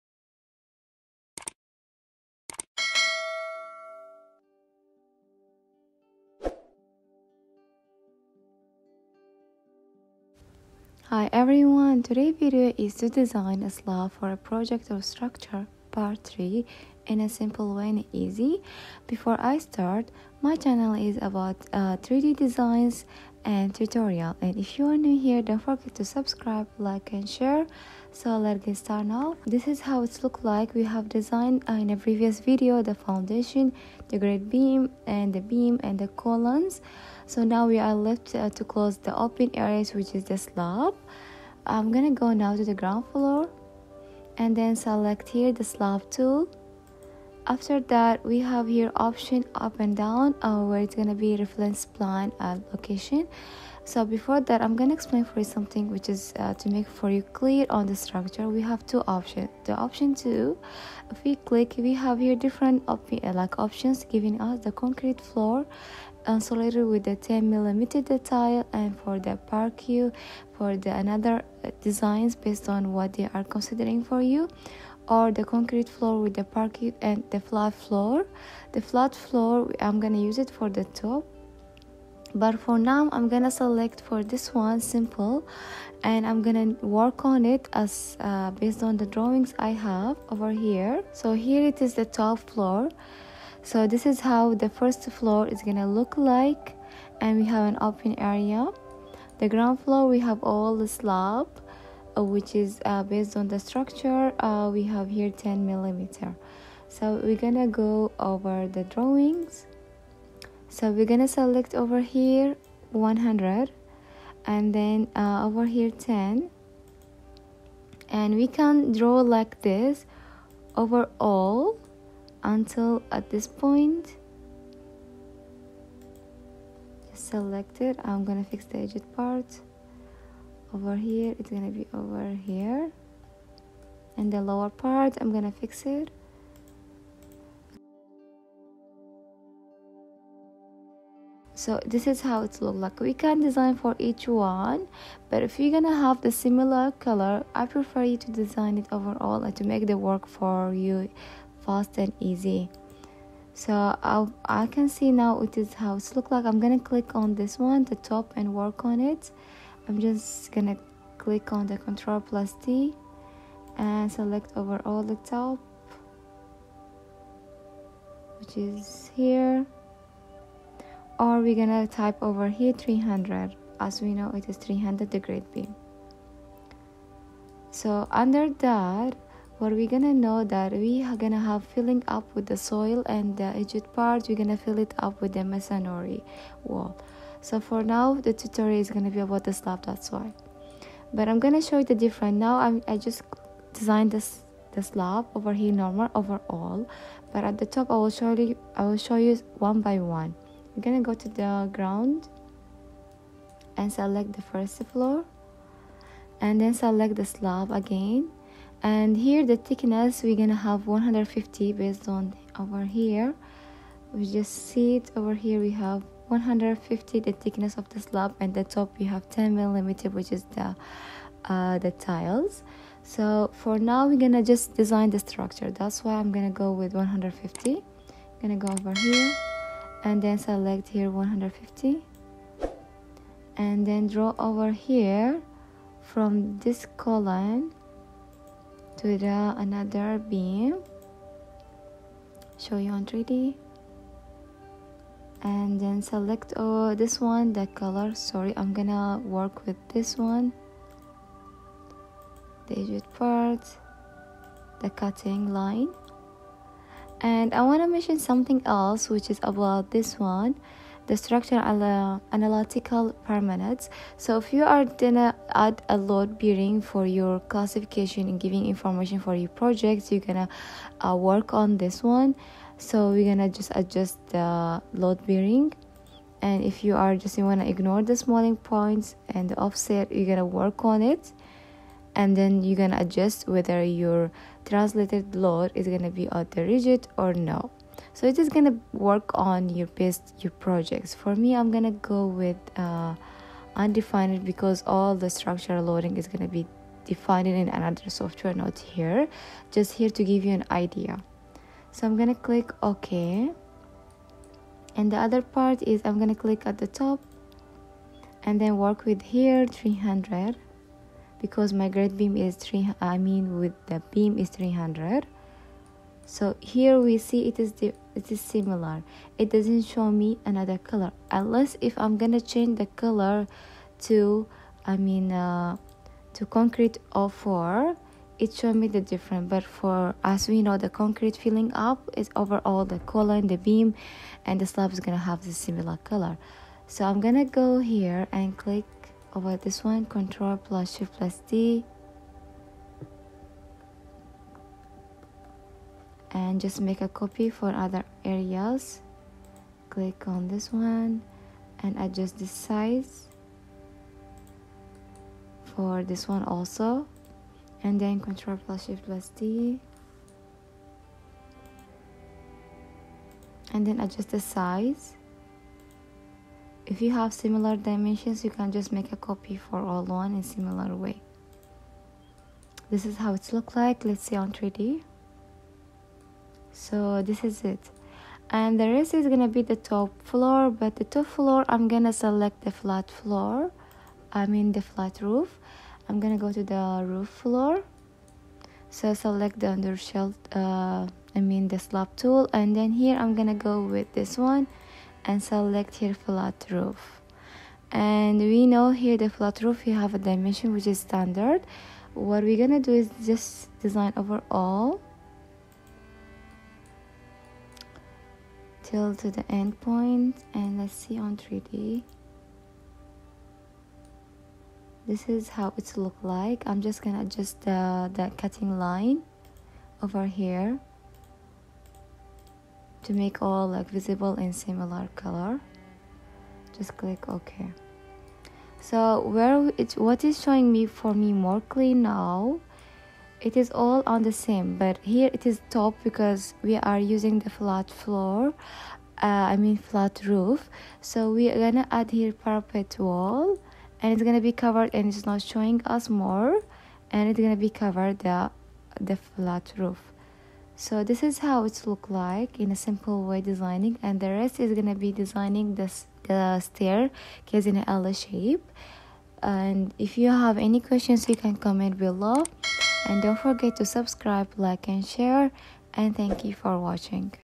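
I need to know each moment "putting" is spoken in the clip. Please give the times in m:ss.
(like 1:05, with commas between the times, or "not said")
not said.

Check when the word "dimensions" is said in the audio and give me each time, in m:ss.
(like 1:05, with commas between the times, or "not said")
6:07, 6:40.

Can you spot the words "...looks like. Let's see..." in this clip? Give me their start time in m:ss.
6:13.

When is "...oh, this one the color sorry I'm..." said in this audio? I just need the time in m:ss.
4:06.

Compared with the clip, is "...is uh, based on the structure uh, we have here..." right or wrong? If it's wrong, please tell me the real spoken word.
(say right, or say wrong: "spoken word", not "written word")
right.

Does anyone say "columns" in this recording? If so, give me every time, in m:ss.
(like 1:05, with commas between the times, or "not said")
0:36, 3:56.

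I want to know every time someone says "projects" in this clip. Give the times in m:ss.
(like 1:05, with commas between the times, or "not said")
0:14, 4:29, 4:50.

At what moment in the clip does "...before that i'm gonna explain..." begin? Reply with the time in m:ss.
0:54.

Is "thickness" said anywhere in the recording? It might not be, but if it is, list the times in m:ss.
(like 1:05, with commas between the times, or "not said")
3:29, 3:37.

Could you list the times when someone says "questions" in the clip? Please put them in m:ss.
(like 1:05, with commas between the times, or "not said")
7:40.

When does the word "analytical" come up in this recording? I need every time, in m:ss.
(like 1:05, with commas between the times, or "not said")
4:22.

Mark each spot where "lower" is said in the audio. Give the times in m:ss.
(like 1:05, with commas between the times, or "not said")
2:14.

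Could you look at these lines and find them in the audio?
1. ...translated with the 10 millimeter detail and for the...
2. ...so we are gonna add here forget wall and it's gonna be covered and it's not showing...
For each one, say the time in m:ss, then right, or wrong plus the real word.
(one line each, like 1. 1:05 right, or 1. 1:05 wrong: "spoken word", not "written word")
1. 1:06 wrong: "insulated", not "translated"
2. 7:21 wrong: "parapet", not "forget".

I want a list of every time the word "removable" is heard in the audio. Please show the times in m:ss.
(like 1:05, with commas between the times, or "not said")
not said.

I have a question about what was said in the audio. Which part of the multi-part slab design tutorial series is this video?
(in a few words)
Part 3.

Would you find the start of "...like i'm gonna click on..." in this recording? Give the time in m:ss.
2:36.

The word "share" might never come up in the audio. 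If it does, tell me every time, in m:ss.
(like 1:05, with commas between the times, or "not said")
0:27, 7:45.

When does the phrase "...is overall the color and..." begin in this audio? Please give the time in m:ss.
5:32.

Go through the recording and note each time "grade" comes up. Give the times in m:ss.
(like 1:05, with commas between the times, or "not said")
5:11.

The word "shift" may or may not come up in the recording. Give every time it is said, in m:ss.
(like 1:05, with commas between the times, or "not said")
5:40, 5:58.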